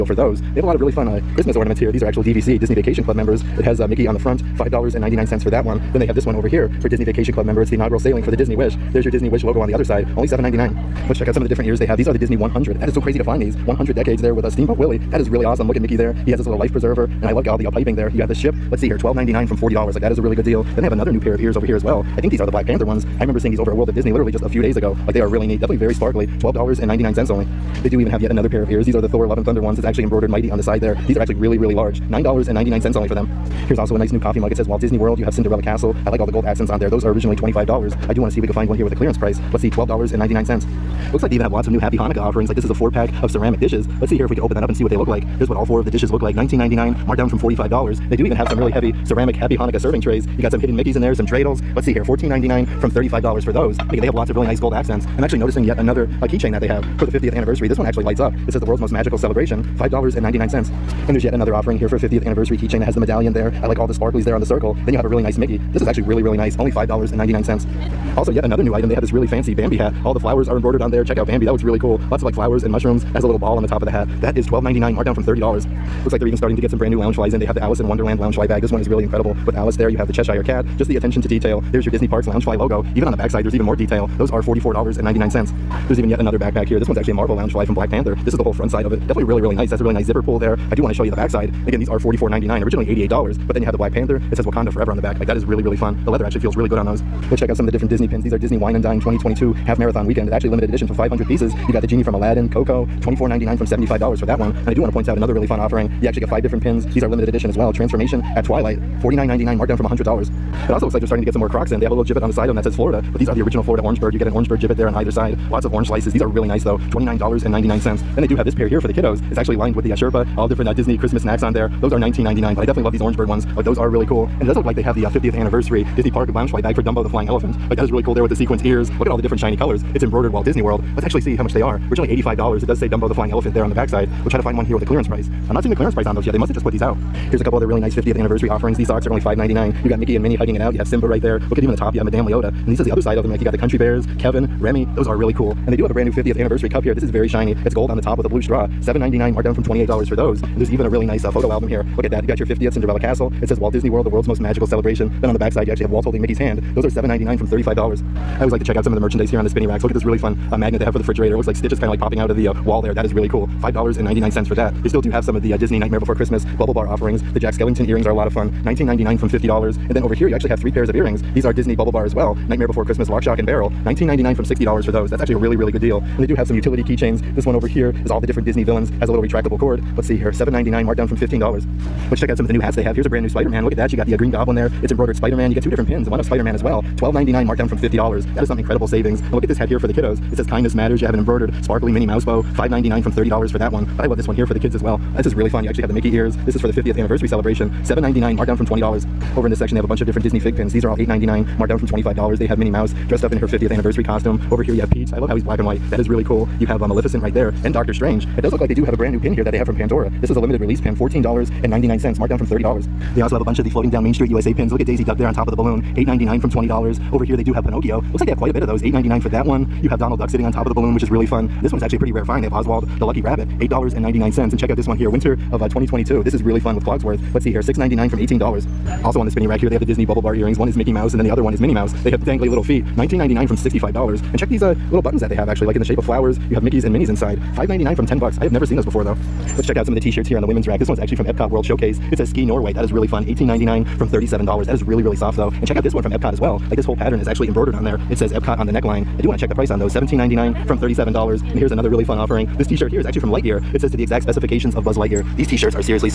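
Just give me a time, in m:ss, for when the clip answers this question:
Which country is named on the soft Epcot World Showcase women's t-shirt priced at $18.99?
4:02.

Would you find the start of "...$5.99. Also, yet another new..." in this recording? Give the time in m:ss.
1:06.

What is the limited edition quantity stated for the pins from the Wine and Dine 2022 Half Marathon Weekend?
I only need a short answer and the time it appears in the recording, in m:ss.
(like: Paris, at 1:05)
500, at 1:40.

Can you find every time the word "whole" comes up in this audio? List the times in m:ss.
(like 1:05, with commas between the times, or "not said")
1:28, 4:06.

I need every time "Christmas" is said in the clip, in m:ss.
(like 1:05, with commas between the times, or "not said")
0:01, 2:00, 2:46, 2:52.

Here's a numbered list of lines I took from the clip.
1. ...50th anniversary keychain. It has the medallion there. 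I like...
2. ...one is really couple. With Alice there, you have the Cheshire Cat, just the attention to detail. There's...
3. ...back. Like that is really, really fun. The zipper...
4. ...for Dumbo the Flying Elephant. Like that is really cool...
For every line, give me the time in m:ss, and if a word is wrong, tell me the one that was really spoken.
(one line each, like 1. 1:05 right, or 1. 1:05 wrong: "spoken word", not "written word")
1. 1:01 right
2. 1:18 wrong: "incredible", not "couple"
3. 1:34 wrong: "leather", not "zipper"
4. 2:06 right.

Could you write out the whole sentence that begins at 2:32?
You got your 50th Cinderella Castle.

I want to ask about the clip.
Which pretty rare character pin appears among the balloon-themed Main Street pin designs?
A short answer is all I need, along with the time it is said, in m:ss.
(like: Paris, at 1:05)
Oswald the Lucky Rabbit, at 3:42.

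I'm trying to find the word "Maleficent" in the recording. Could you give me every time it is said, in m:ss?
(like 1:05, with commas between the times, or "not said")
3:26.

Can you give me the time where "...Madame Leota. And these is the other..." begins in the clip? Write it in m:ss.
2:22.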